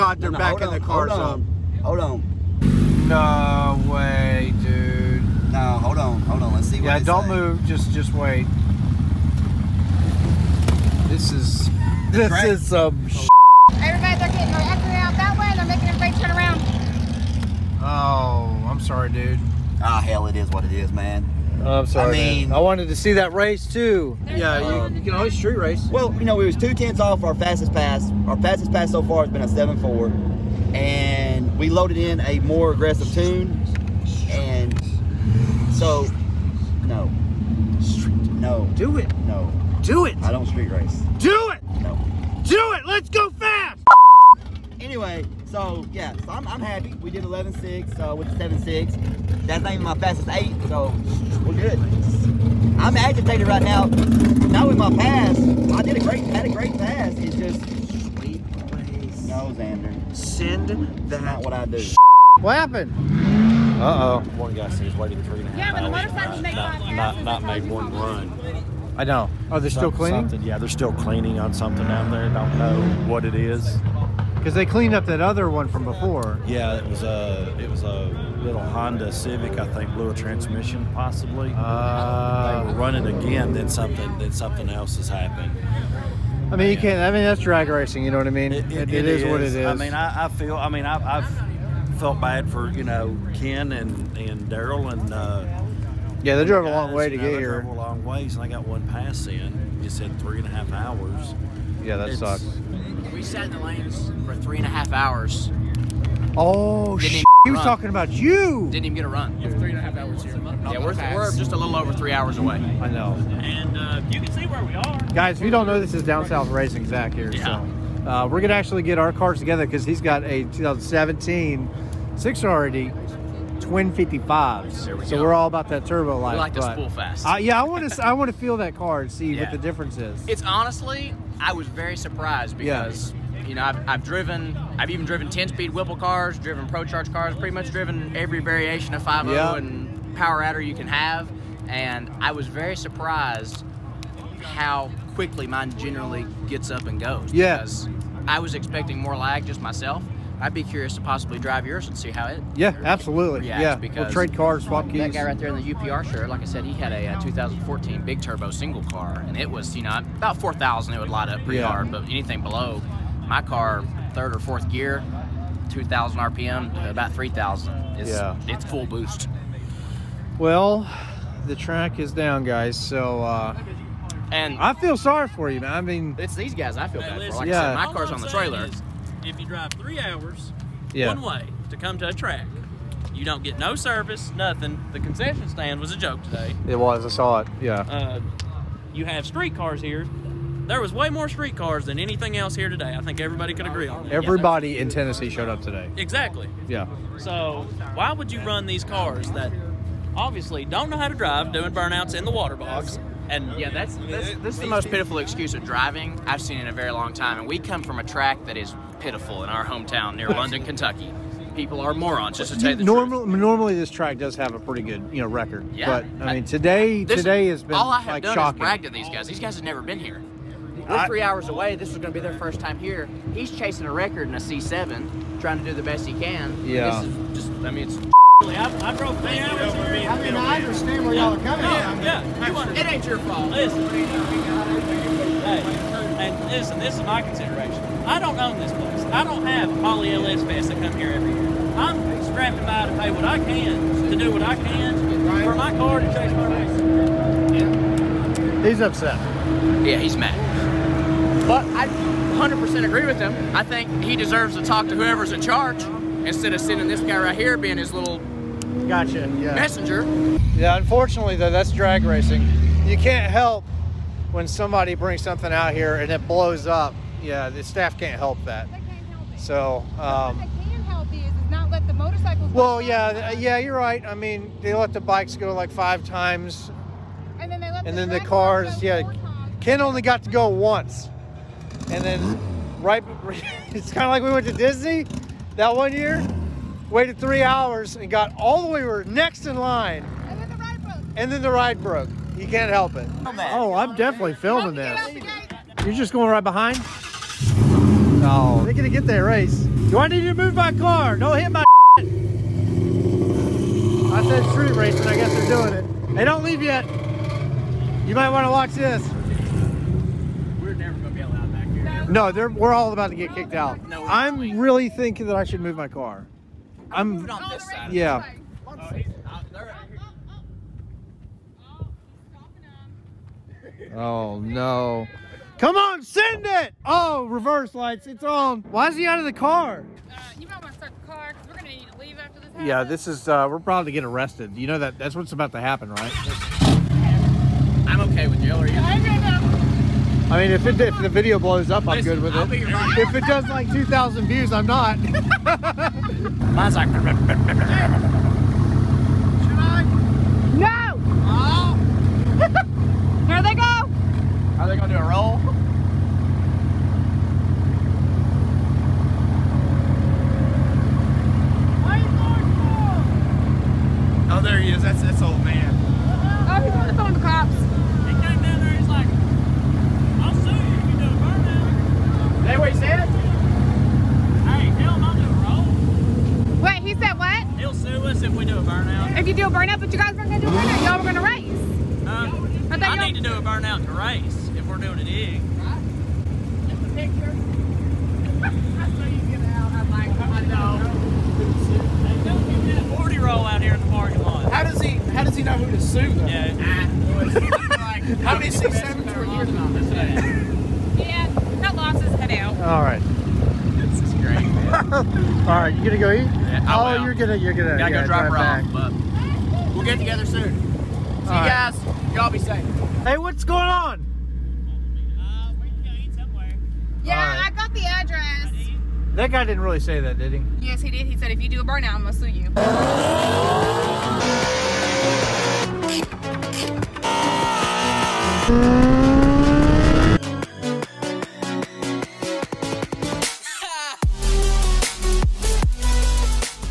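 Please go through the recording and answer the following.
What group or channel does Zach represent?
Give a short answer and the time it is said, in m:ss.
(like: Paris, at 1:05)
Down South Racing, at 1:56.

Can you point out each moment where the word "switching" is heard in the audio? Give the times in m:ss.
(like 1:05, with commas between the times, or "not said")
not said.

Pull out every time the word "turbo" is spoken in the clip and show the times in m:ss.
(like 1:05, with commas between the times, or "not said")
2:05, 2:38.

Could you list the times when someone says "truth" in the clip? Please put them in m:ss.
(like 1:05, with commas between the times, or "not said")
3:33.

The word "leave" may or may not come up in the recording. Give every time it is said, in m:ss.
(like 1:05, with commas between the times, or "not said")
5:06, 5:31.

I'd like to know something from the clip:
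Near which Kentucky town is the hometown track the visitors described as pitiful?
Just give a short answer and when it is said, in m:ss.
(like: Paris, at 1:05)
London, at 3:30.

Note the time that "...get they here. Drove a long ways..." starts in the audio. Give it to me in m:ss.
1:37.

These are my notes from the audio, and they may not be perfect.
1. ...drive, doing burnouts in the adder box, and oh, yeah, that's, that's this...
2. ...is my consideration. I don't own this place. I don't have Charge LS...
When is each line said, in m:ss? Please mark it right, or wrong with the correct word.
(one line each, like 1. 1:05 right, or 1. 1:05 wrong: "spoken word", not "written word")
1. 3:21 wrong: "water", not "adder"
2. 3:56 wrong: "Holley", not "Charge".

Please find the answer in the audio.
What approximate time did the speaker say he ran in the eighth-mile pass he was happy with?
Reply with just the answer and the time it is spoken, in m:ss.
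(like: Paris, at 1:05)
7.6, at 0:48.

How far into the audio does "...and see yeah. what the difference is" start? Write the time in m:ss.
2:09.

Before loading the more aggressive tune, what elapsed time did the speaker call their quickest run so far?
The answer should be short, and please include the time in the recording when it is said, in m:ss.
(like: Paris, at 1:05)
7.4, at 0:29.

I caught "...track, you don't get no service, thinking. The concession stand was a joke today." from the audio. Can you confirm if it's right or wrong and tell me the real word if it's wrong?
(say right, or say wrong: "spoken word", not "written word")
wrong: "nothing", not "thinking".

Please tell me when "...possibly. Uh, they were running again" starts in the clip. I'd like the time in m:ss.
1:20.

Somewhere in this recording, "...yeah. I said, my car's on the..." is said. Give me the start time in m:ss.
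2:57.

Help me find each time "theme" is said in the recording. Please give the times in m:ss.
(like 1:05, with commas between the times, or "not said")
not said.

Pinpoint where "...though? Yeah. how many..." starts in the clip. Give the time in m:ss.
6:36.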